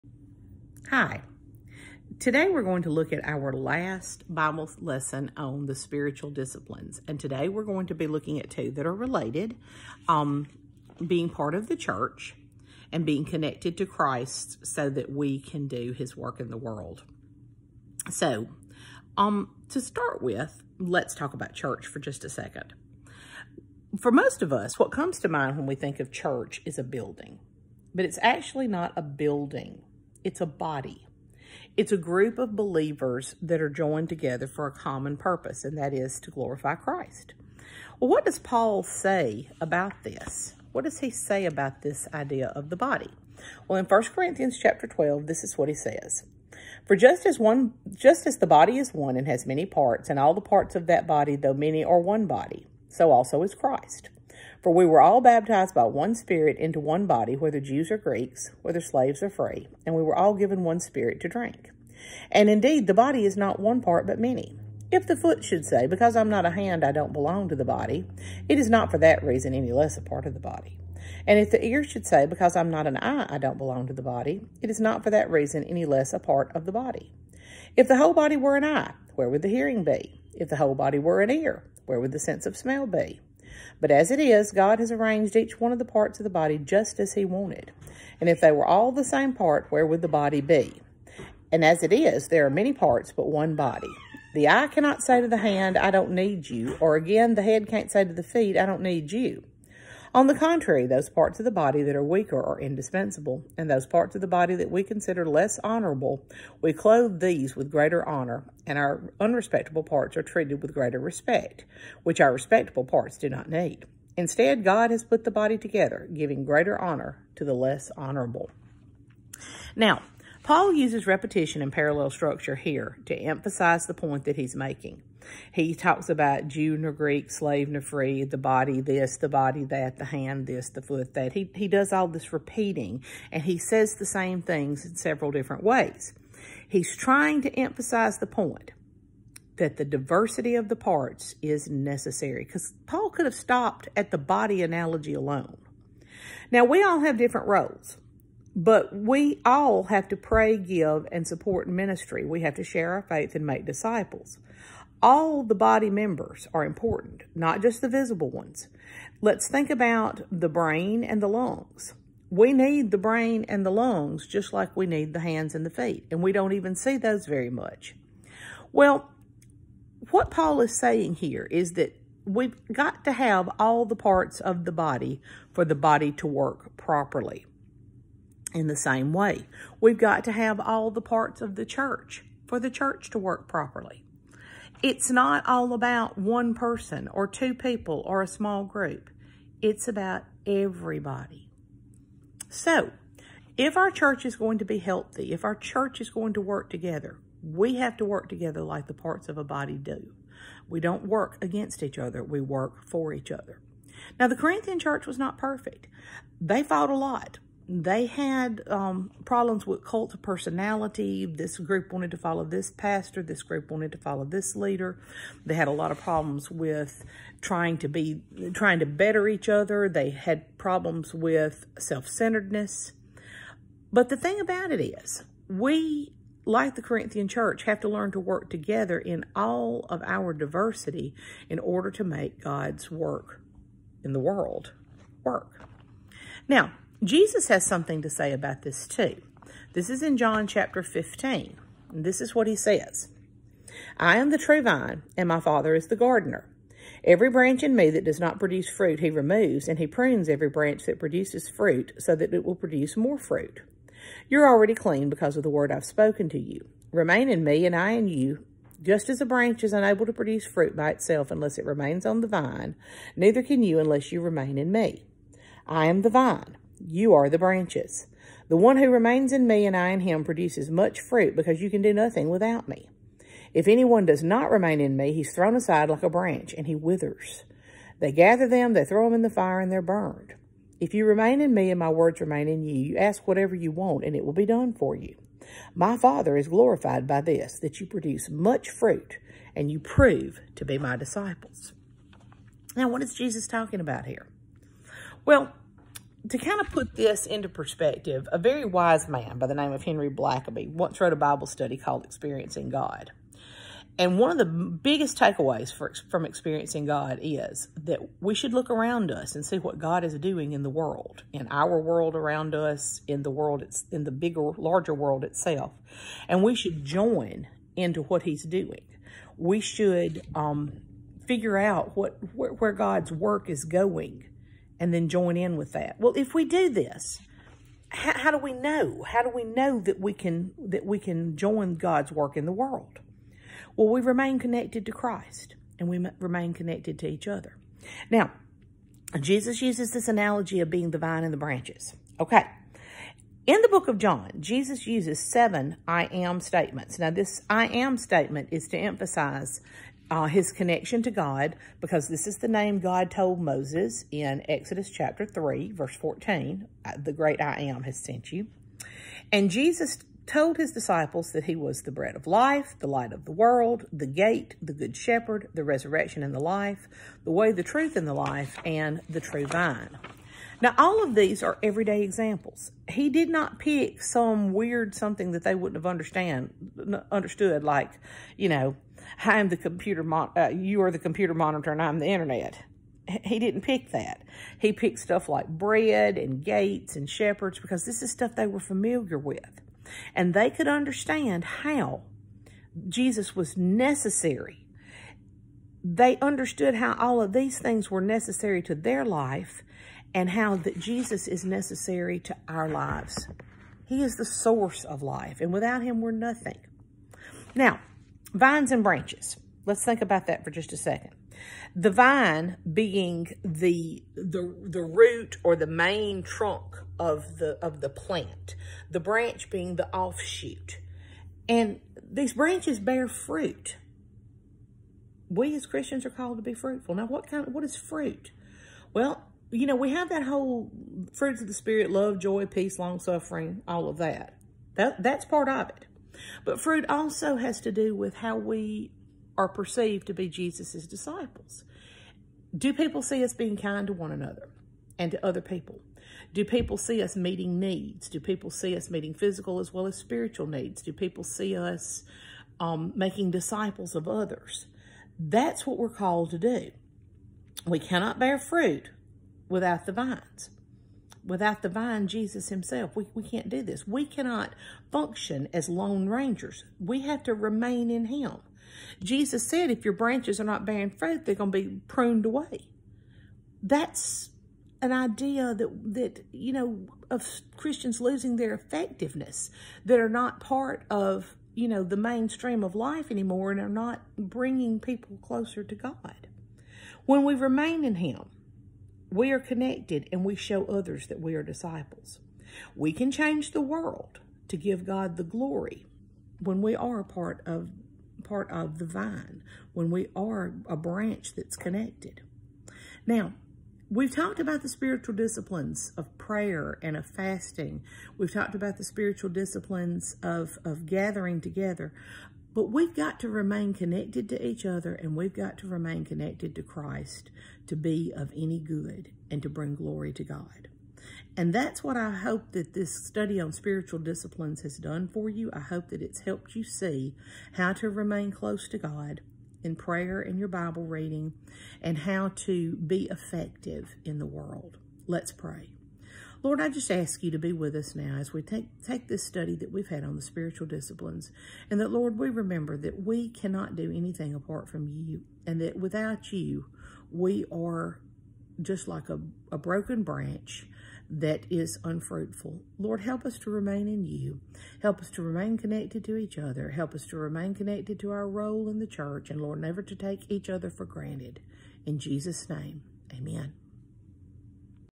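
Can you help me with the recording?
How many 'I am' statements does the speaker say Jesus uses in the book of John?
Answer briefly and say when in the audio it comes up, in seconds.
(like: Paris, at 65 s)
7, at 345 s.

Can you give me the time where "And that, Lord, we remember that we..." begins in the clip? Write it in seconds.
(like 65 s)
541 s.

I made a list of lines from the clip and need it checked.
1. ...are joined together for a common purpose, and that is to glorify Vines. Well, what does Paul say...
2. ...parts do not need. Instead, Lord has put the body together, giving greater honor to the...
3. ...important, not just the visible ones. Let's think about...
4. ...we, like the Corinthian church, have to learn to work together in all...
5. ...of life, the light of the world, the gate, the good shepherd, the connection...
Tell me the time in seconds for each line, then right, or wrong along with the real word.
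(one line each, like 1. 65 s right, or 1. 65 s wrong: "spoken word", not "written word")
1. 33 s wrong: "Christ", not "Vines"
2. 112 s wrong: "God", not "Lord"
3. 156 s right
4. 225 s right
5. 362 s wrong: "resurrection", not "connection".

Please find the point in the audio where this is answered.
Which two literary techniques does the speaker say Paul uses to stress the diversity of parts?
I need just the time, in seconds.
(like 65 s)
121 s.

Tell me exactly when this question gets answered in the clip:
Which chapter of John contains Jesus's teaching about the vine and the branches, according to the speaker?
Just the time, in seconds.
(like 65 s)
240 s.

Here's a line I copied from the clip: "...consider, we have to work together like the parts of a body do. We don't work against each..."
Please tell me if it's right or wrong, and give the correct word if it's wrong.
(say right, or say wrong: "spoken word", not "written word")
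wrong: "together", not "consider".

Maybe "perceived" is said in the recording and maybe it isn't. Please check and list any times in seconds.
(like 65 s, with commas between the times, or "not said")
439 s.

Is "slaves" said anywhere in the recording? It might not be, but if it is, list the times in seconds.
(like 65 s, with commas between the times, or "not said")
58 s, 127 s.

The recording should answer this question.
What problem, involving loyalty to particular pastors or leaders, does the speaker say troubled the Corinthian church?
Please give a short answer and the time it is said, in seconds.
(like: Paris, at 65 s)
Cult of personality, at 209 s.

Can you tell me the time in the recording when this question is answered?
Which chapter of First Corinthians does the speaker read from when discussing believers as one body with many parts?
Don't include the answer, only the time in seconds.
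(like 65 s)
43 s.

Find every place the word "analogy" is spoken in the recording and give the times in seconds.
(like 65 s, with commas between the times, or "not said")
144 s, 340 s.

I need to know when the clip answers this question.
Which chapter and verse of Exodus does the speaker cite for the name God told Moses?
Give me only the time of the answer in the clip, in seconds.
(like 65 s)
354 s.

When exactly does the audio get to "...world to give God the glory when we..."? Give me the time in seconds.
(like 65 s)
493 s.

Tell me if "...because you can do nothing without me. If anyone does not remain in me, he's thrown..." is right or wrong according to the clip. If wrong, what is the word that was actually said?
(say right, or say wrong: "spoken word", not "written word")
right.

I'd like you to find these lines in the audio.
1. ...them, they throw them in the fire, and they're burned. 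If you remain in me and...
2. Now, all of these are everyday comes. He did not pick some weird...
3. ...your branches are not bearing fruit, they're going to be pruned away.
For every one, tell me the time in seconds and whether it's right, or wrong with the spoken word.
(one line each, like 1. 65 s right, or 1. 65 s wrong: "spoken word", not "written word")
1. 278 s right
2. 370 s wrong: "examples", not "comes"
3. 469 s right.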